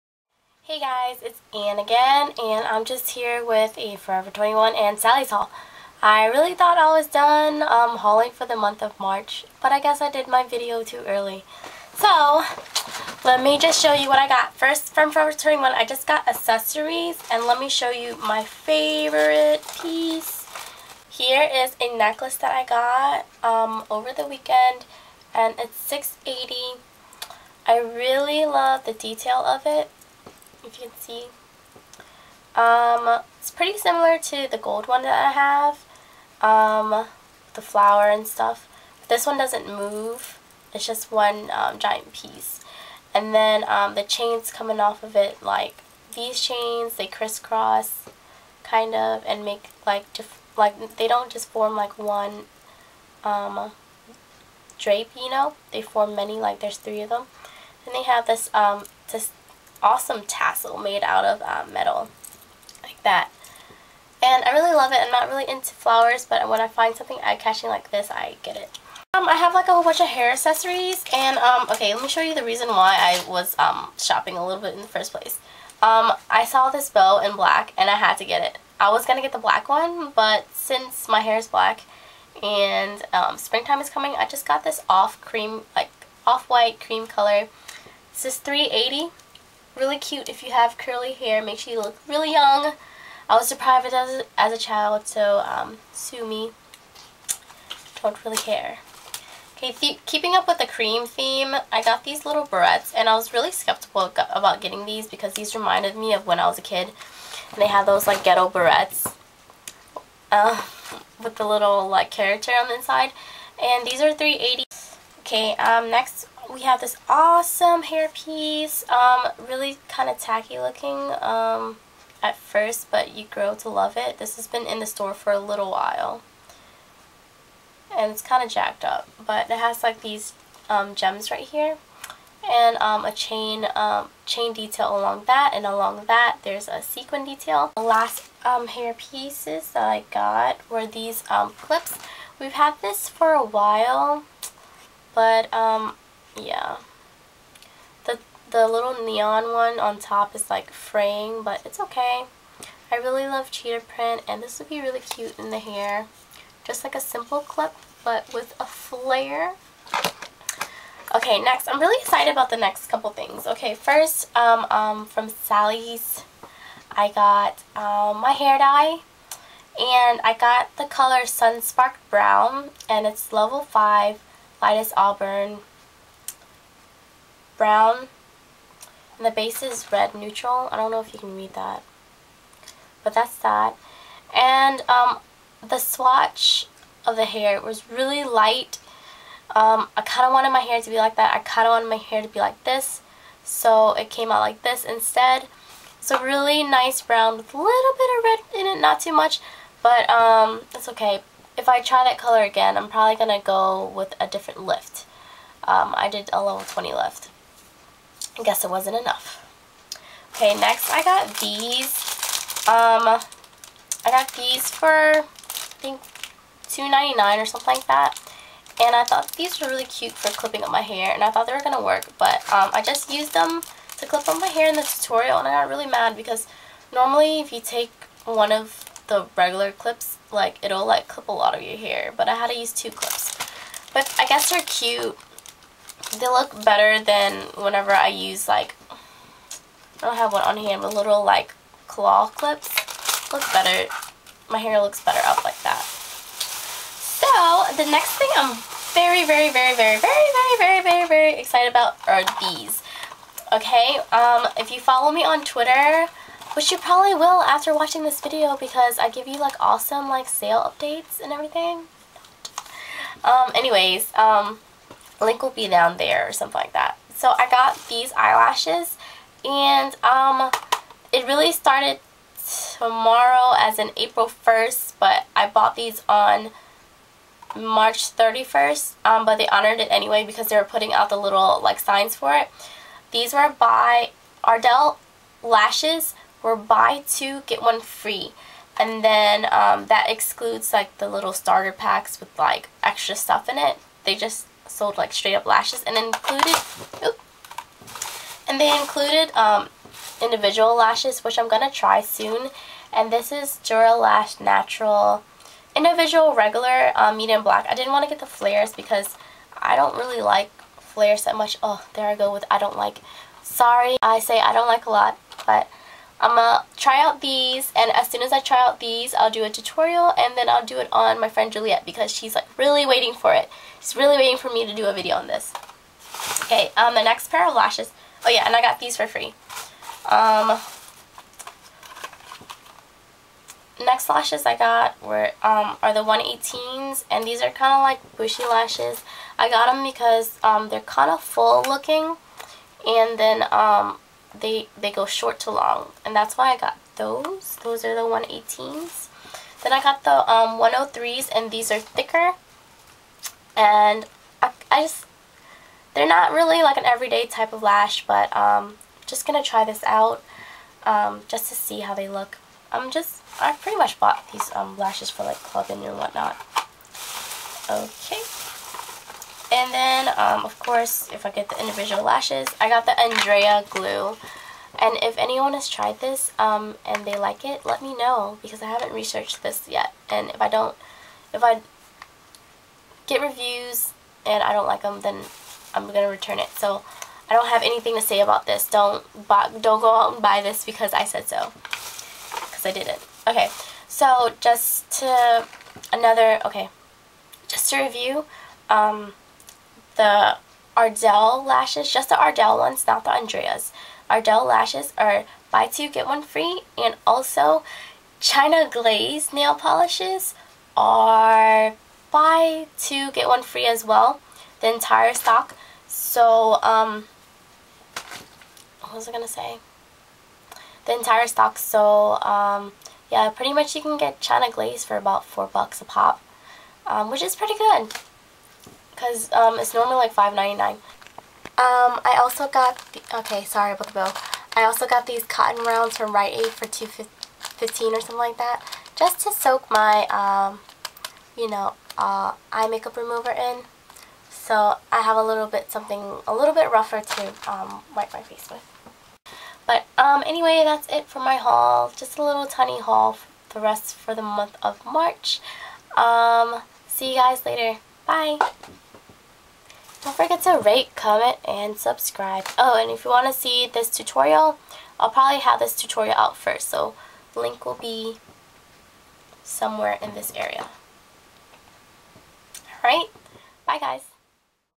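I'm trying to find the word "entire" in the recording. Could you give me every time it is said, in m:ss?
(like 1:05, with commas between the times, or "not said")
6:54, 7:00.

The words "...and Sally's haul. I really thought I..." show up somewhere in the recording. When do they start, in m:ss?
0:04.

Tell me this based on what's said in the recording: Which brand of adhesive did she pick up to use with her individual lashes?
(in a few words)
Andrea.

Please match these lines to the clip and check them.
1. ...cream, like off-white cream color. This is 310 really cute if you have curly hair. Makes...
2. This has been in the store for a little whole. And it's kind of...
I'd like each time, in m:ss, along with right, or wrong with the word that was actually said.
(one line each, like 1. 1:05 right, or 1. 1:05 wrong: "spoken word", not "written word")
1. 1:25 wrong: "380", not "310"
2. 2:04 wrong: "while", not "whole".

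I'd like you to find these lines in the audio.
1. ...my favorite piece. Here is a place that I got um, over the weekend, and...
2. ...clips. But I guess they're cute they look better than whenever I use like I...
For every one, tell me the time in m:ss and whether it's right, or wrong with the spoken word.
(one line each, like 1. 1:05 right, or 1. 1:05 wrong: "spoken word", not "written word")
1. 0:18 wrong: "necklace", not "place"
2. 3:52 right.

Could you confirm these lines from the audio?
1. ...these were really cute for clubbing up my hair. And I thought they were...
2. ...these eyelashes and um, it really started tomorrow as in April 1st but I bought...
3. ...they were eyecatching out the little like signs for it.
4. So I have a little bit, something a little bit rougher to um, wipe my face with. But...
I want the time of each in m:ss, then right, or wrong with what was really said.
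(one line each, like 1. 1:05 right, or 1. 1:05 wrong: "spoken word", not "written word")
1. 3:39 wrong: "clipping", not "clubbing"
2. 4:27 right
3. 4:40 wrong: "putting", not "eyecatching"
4. 7:24 right.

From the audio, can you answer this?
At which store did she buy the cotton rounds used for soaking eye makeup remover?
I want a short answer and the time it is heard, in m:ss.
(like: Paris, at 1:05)
Rite Aid, at 7:16.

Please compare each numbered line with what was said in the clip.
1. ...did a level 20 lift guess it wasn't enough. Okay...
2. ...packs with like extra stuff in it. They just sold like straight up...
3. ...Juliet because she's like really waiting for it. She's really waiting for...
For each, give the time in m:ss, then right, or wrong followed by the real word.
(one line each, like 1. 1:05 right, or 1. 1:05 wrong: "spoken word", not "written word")
1. 3:26 right
2. 4:51 right
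3. 5:21 right.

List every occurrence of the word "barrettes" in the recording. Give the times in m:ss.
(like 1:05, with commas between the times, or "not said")
1:42, 1:48.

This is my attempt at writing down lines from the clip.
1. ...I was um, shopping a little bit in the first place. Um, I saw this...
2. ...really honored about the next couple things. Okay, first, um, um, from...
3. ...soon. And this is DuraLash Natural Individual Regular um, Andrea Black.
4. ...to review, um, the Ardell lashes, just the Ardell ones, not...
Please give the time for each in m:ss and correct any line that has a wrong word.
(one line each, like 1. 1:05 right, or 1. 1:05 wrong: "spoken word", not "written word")
1. 1:12 right
2. 2:41 wrong: "excited", not "honored"
3. 5:02 wrong: "Medium", not "Andrea"
4. 6:37 right.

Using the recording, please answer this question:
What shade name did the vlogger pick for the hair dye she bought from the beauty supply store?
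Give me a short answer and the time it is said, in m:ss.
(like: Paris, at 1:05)
Sunsparked Brown, at 2:51.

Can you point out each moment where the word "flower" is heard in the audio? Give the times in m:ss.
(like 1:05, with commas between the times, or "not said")
0:37, 1:05.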